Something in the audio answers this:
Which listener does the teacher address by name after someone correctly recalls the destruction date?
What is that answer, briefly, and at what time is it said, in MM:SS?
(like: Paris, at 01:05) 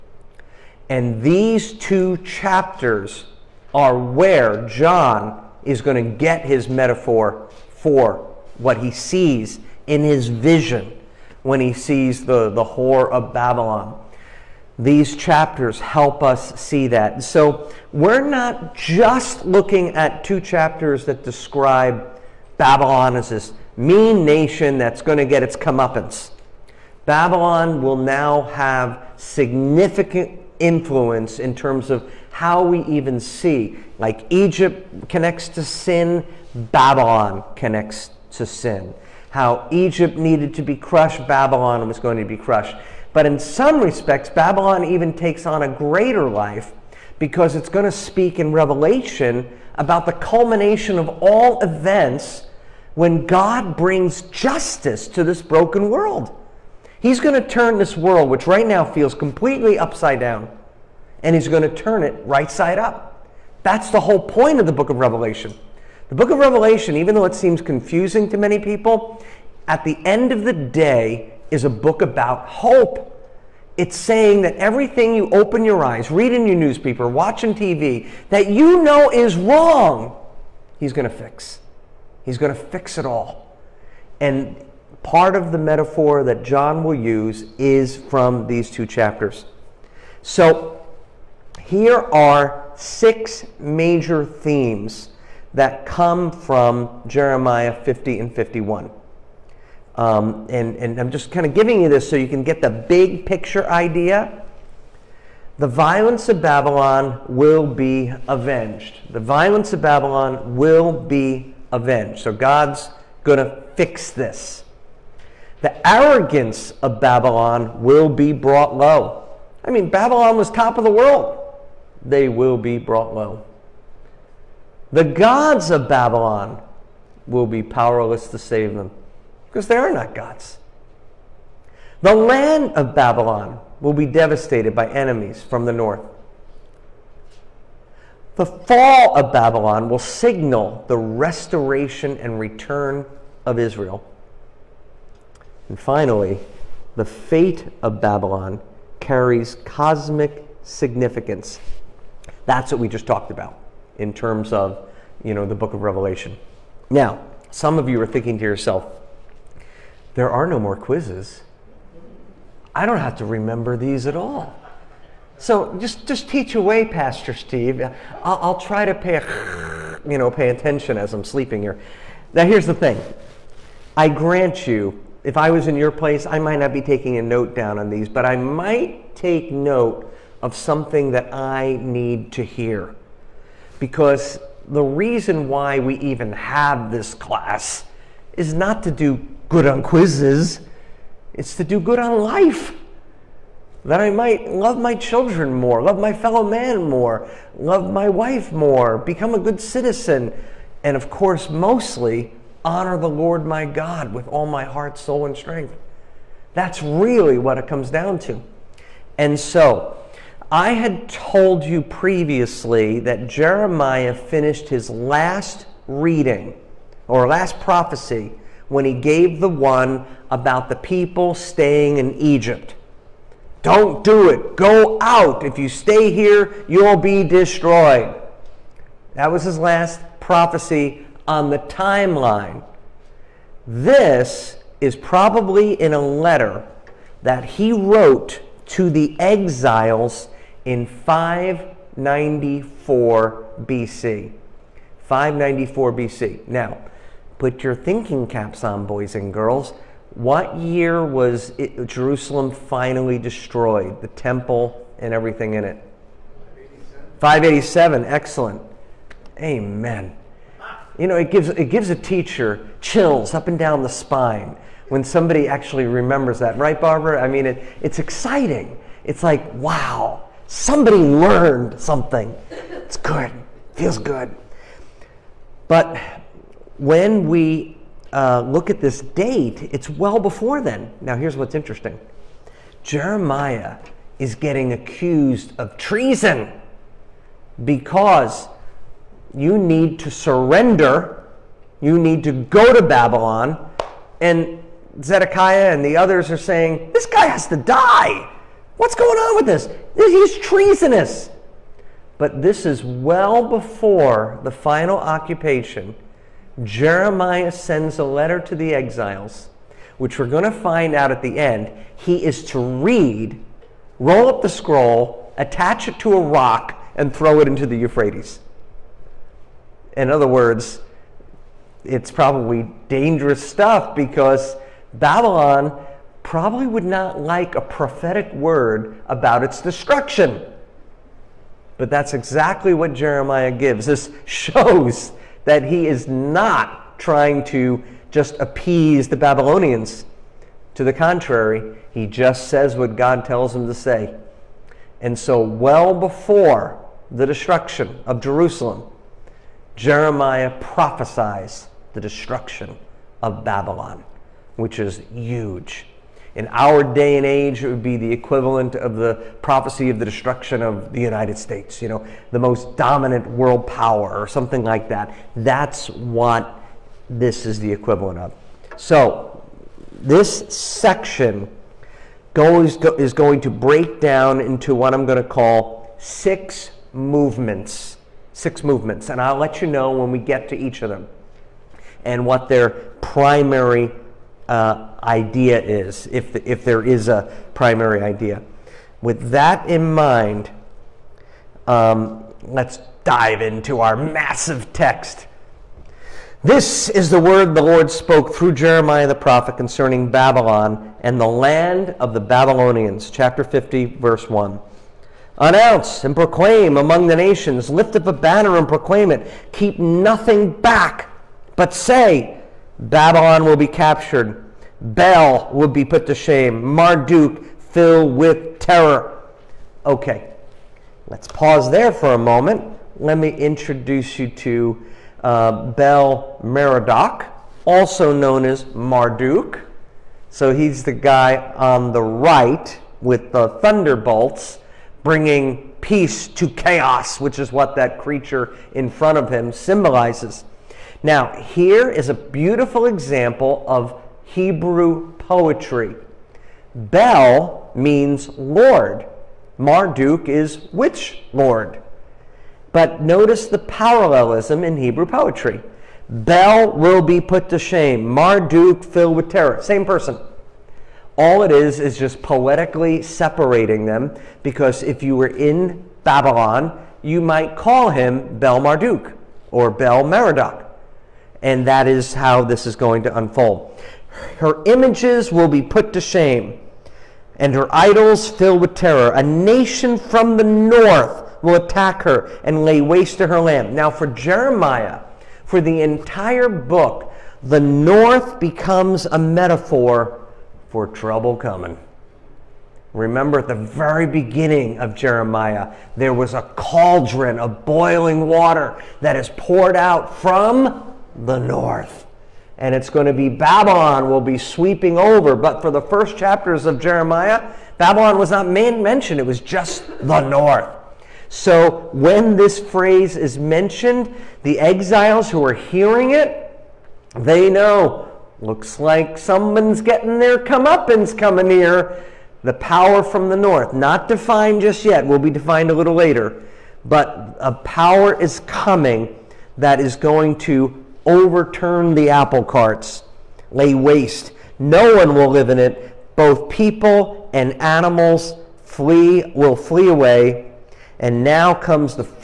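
Barbara, at 04:26.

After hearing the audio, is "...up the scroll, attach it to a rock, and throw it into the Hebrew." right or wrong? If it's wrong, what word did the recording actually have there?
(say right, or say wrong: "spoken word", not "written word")
wrong: "Euphrates", not "Hebrew".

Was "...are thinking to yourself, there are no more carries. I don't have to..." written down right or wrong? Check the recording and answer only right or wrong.
wrong.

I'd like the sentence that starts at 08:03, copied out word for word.
Now, for Jeremiah, for the entire book, the north becomes a metaphor for trouble coming.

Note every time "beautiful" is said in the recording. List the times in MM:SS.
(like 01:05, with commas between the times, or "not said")
07:22.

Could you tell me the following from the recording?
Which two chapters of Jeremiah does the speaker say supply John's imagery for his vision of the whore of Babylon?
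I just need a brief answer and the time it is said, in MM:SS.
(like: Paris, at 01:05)
Jeremiah 50 and 51, at 01:37.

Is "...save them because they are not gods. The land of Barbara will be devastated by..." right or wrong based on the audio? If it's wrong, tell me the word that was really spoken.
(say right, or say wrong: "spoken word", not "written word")
wrong: "Babylon", not "Barbara".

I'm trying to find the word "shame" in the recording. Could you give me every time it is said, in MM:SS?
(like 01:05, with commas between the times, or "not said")
06:56, 07:37, 07:55.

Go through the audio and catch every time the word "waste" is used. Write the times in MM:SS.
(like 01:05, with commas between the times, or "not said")
08:02, 08:53.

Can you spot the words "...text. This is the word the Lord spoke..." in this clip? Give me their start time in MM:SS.
06:34.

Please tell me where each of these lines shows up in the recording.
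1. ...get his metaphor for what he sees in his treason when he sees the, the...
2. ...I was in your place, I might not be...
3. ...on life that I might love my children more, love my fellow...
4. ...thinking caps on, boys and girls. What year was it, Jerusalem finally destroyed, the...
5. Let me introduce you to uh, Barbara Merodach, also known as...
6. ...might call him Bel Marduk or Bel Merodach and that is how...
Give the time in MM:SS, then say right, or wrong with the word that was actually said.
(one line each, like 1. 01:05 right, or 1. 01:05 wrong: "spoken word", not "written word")
1. 00:06 wrong: "vision", not "treason"
2. 02:55 right
3. 03:11 right
4. 04:07 right
5. 07:02 wrong: "Bel", not "Barbara"
6. 07:47 right.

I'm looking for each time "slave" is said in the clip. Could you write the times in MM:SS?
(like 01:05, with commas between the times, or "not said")
not said.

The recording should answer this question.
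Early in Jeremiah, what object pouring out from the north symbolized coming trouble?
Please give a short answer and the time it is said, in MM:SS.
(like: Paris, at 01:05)
Cauldron of boiling water, at 08:16.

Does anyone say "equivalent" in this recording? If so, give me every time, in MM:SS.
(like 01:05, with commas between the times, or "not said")
05:58, 06:07.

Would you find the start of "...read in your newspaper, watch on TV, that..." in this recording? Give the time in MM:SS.
01:16.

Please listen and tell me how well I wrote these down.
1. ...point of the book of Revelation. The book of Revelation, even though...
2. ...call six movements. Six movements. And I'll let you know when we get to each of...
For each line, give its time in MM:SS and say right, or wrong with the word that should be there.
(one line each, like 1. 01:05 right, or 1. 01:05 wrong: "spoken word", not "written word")
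1. 01:04 right
2. 06:15 right.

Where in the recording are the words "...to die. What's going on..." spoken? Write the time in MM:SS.
04:57.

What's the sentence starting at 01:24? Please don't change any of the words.
And part of the metaphor that John will use is from these two chapters.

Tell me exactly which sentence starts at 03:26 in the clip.
That's really what it comes down to.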